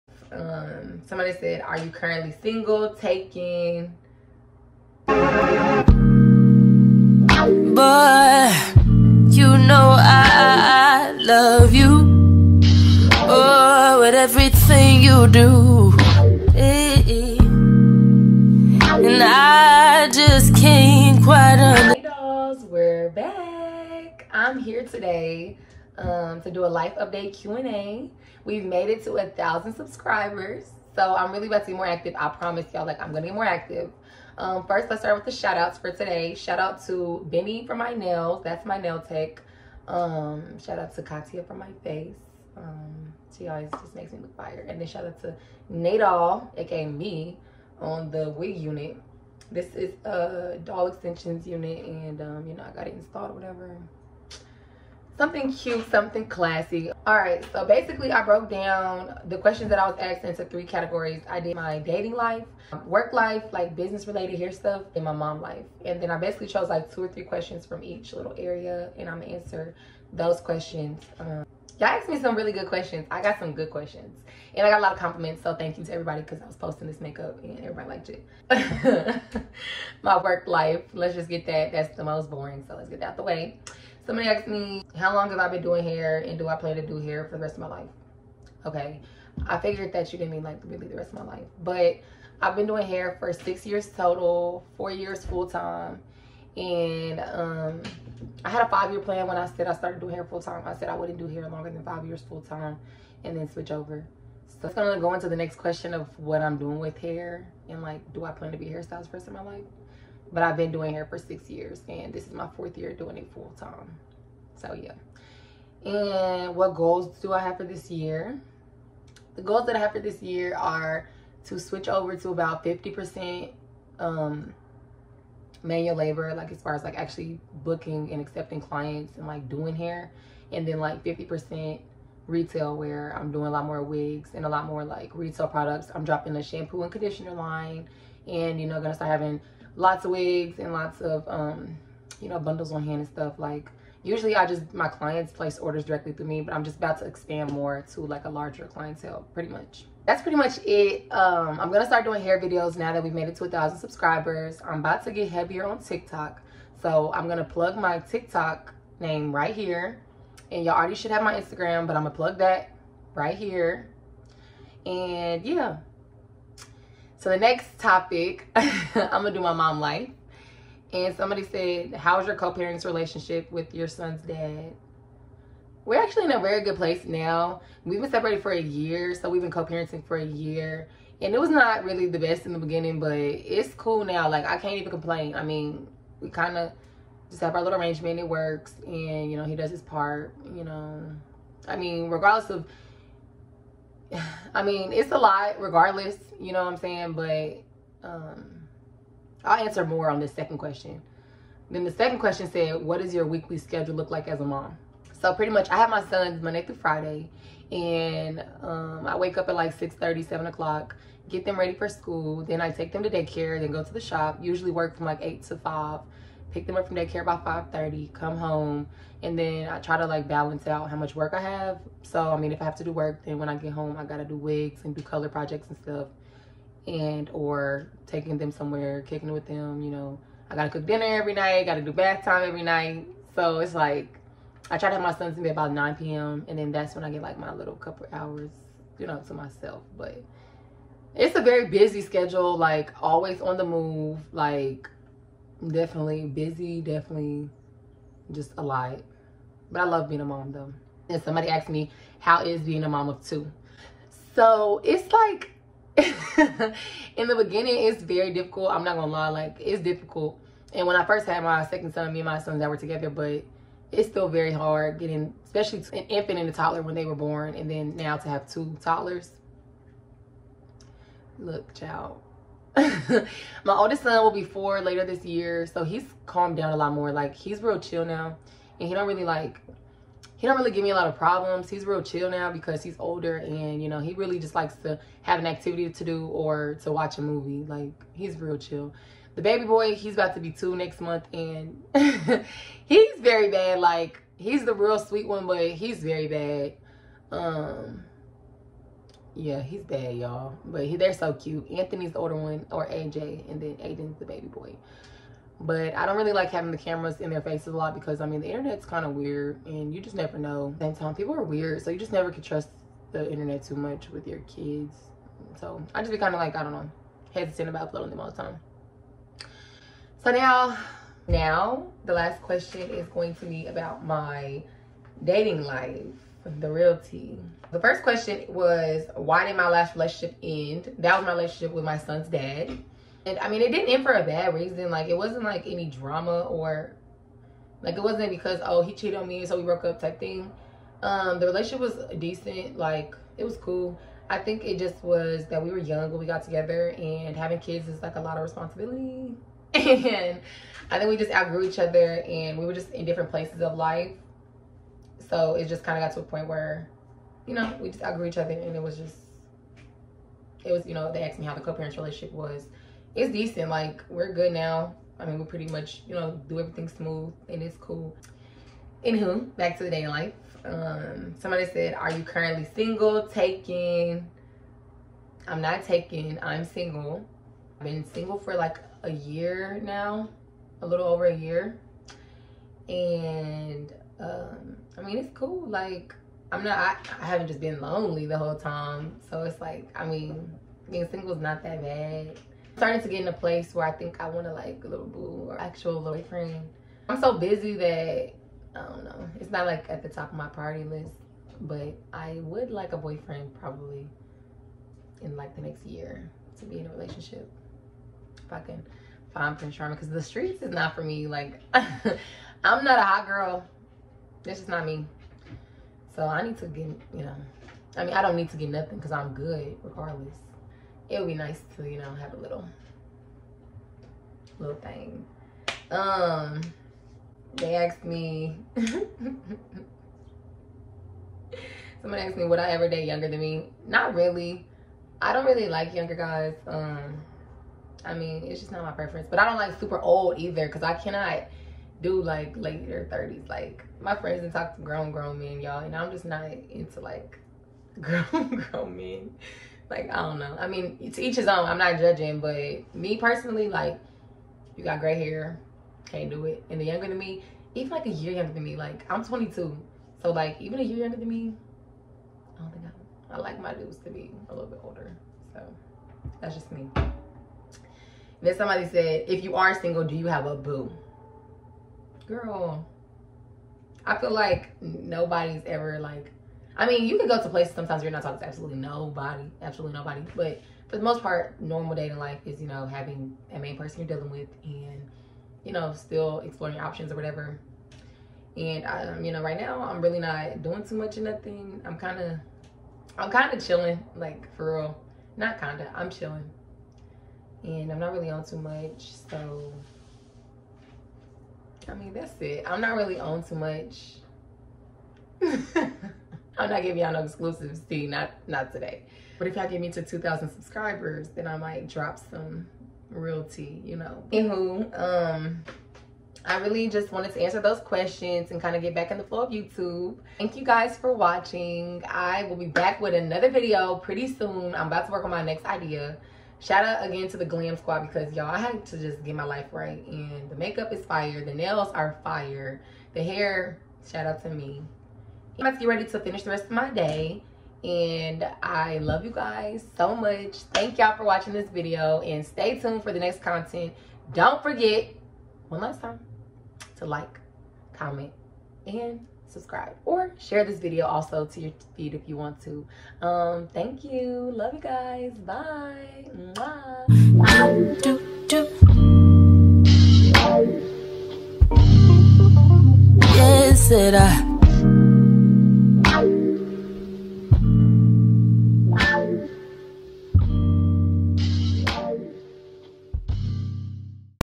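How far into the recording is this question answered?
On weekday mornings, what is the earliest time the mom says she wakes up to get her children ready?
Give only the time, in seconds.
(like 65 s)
209 s.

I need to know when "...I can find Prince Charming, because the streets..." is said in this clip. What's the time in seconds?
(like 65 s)
408 s.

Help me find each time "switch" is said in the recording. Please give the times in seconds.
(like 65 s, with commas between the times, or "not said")
103 s, 121 s.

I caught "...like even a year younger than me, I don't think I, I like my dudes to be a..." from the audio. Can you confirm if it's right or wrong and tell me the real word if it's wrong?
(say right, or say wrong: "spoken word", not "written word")
right.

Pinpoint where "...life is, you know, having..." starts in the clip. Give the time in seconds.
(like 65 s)
482 s.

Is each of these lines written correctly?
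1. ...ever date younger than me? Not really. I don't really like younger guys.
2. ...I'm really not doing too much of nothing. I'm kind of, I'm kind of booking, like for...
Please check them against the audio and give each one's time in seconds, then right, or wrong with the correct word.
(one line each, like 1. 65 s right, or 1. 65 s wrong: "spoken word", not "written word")
1. 432 s right
2. 489 s wrong: "chilling", not "booking".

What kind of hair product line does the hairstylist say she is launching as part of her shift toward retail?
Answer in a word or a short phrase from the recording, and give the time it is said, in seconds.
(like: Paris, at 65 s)
shampoo and conditioner, at 136 s.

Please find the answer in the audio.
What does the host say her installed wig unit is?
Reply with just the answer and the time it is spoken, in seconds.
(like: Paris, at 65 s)
doll extensions, at 50 s.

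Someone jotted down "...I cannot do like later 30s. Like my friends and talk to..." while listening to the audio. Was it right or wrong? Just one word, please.
right.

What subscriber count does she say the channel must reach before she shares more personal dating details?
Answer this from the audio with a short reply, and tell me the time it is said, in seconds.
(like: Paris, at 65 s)
2,000, at 510 s.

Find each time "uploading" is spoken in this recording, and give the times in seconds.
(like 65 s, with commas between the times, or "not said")
317 s.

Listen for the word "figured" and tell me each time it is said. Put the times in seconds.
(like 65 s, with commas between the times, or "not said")
89 s.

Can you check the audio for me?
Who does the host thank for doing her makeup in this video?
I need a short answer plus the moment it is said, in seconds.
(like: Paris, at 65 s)
Katia, at 41 s.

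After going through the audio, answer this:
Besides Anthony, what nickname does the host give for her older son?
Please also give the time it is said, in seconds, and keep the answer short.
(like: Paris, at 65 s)
AJ, at 302 s.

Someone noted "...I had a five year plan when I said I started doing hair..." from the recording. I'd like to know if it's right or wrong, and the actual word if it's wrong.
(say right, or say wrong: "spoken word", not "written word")
right.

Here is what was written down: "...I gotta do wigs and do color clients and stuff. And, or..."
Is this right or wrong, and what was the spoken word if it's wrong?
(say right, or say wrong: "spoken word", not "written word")
wrong: "projects", not "clients".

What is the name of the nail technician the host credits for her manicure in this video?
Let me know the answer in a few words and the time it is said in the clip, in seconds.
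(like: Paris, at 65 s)
Benny, at 37 s.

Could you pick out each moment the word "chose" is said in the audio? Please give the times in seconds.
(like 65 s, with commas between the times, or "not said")
66 s.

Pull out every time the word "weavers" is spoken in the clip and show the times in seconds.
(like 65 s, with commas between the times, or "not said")
not said.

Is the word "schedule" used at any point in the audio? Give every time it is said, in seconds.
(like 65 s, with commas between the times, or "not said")
203 s, 242 s.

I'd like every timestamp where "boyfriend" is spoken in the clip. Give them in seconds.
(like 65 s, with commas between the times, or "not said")
396 s, 402 s.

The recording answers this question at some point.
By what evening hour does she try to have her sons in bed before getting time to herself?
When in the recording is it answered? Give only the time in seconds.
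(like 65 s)
235 s.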